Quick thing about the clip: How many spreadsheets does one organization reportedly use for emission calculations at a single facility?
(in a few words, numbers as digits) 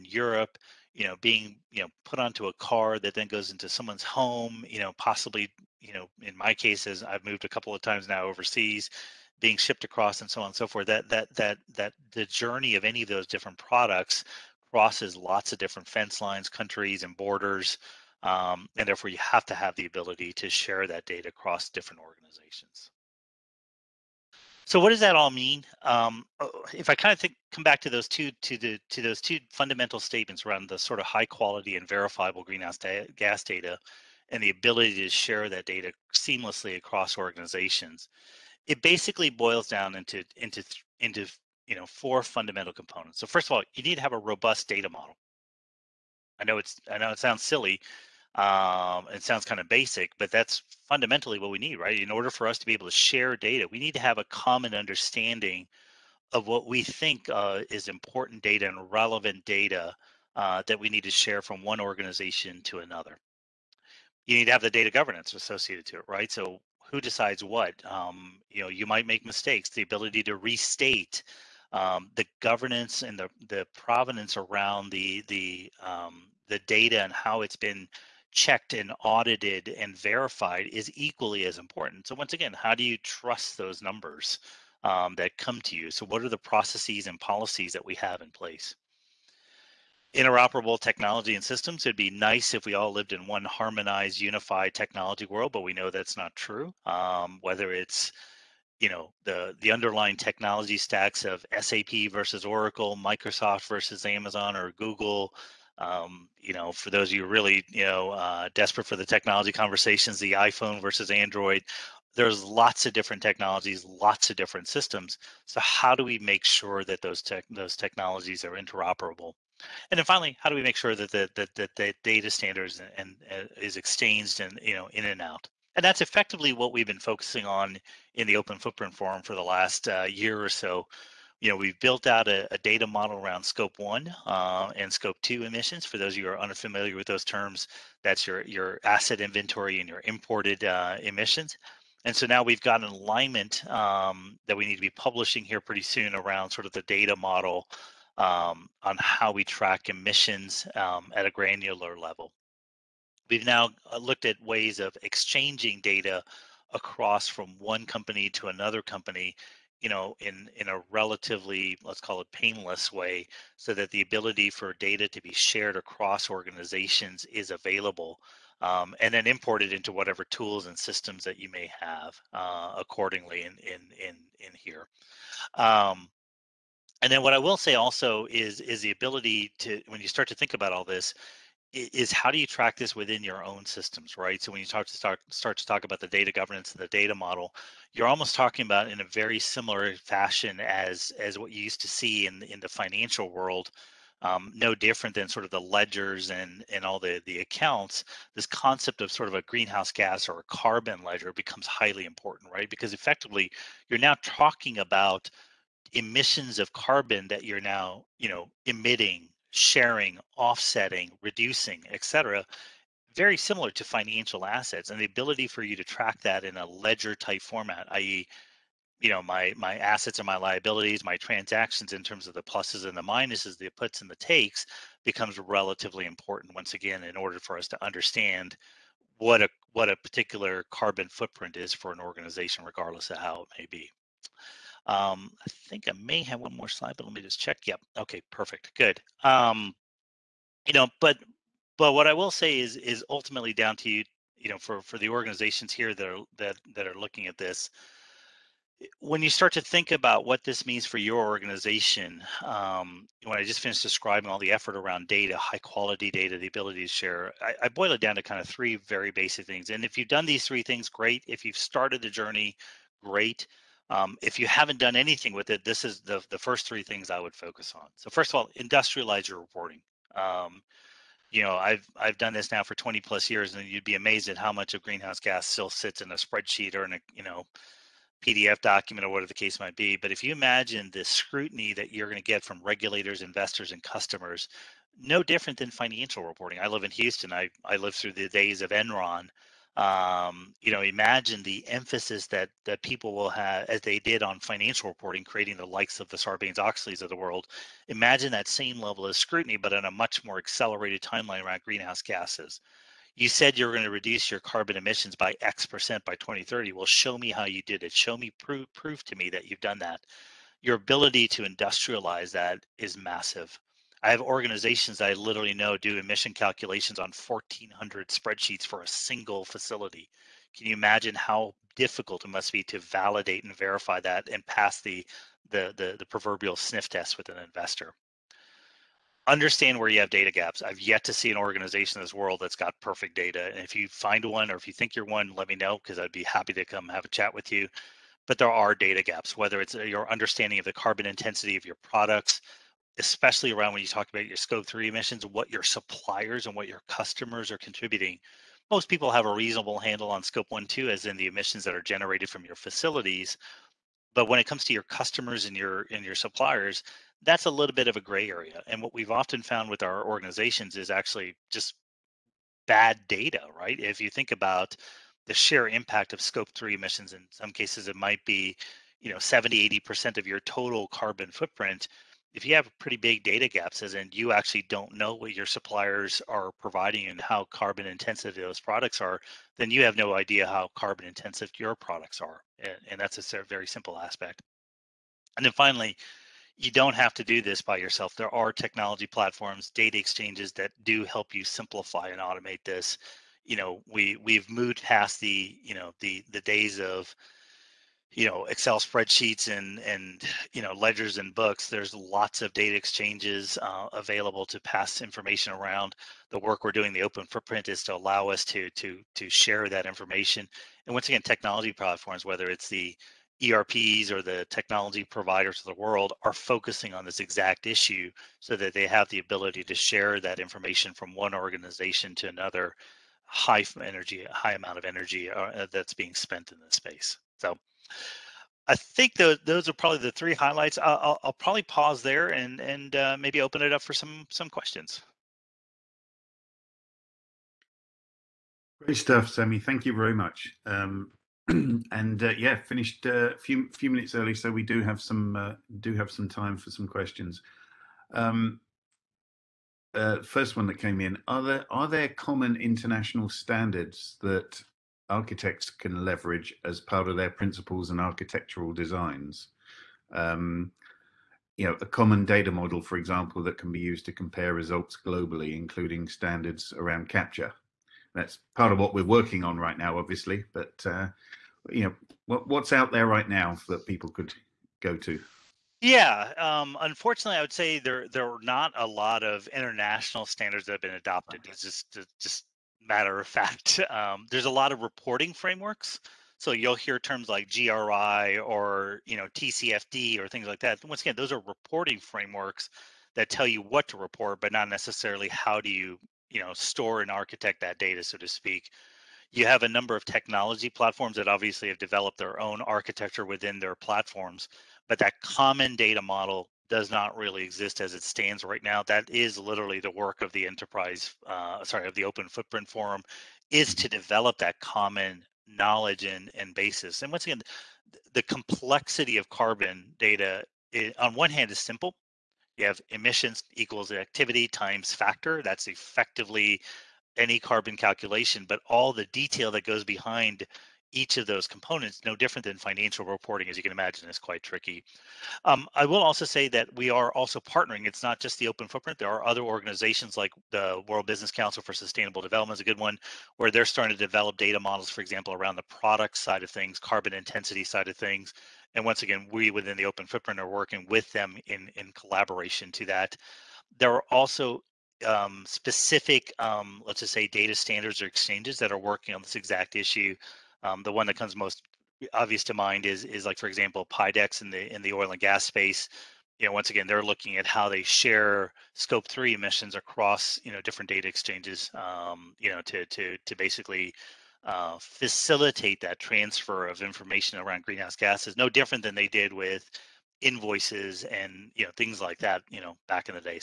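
1,400.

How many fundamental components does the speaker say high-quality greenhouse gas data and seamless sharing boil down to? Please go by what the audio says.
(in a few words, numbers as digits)
4.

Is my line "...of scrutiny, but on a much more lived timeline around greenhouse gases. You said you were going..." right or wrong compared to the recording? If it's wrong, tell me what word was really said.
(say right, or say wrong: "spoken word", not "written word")
wrong: "accelerated", not "lived".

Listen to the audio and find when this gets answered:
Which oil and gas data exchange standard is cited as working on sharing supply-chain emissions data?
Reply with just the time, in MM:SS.
09:23.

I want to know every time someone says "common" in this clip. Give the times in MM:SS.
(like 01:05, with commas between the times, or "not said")
00:54, 07:32, 07:41, 08:25, 08:34.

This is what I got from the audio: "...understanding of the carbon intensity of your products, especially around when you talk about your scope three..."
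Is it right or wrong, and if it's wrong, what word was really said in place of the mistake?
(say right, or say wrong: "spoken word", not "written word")
right.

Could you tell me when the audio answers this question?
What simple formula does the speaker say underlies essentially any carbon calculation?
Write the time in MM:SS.
08:42.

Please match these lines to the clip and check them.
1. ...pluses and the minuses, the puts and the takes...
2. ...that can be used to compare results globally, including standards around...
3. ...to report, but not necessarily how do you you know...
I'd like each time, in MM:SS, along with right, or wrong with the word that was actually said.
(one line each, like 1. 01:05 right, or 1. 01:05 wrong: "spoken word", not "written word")
1. 03:42 right
2. 07:43 right
3. 08:13 right.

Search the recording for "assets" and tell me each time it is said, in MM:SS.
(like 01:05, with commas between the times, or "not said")
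02:18, 03:34, 03:39.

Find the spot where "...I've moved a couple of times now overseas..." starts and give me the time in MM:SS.
00:07.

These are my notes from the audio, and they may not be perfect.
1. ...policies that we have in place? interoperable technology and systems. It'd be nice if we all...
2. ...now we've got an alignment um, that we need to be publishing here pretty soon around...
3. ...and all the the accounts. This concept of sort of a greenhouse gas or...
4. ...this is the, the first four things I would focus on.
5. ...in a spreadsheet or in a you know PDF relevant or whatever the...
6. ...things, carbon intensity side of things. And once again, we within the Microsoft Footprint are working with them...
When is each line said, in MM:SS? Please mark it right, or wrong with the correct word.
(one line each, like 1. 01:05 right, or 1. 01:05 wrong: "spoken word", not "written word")
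1. 01:27 right
2. 02:22 right
3. 03:16 right
4. 04:25 wrong: "three", not "four"
5. 04:36 wrong: "document", not "relevant"
6. 09:06 wrong: "Open", not "Microsoft".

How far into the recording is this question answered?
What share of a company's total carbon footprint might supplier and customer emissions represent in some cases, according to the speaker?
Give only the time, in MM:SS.
06:09.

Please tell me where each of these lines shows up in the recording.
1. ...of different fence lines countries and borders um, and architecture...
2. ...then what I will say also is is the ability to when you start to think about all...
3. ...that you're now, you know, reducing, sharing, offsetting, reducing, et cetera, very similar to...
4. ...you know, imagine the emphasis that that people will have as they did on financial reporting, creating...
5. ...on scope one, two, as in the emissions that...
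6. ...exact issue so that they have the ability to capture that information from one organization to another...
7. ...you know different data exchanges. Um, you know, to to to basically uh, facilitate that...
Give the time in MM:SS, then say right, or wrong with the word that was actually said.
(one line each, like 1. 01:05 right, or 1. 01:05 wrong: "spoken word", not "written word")
1. 00:15 wrong: "therefore", not "architecture"
2. 02:57 right
3. 03:27 wrong: "emitting", not "reducing"
4. 04:50 right
5. 05:50 right
6. 06:57 wrong: "share", not "capture"
7. 09:30 right.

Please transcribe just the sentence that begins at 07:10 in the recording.
I'll, I'll, probably pause there and and uh, maybe open it up for some some questions.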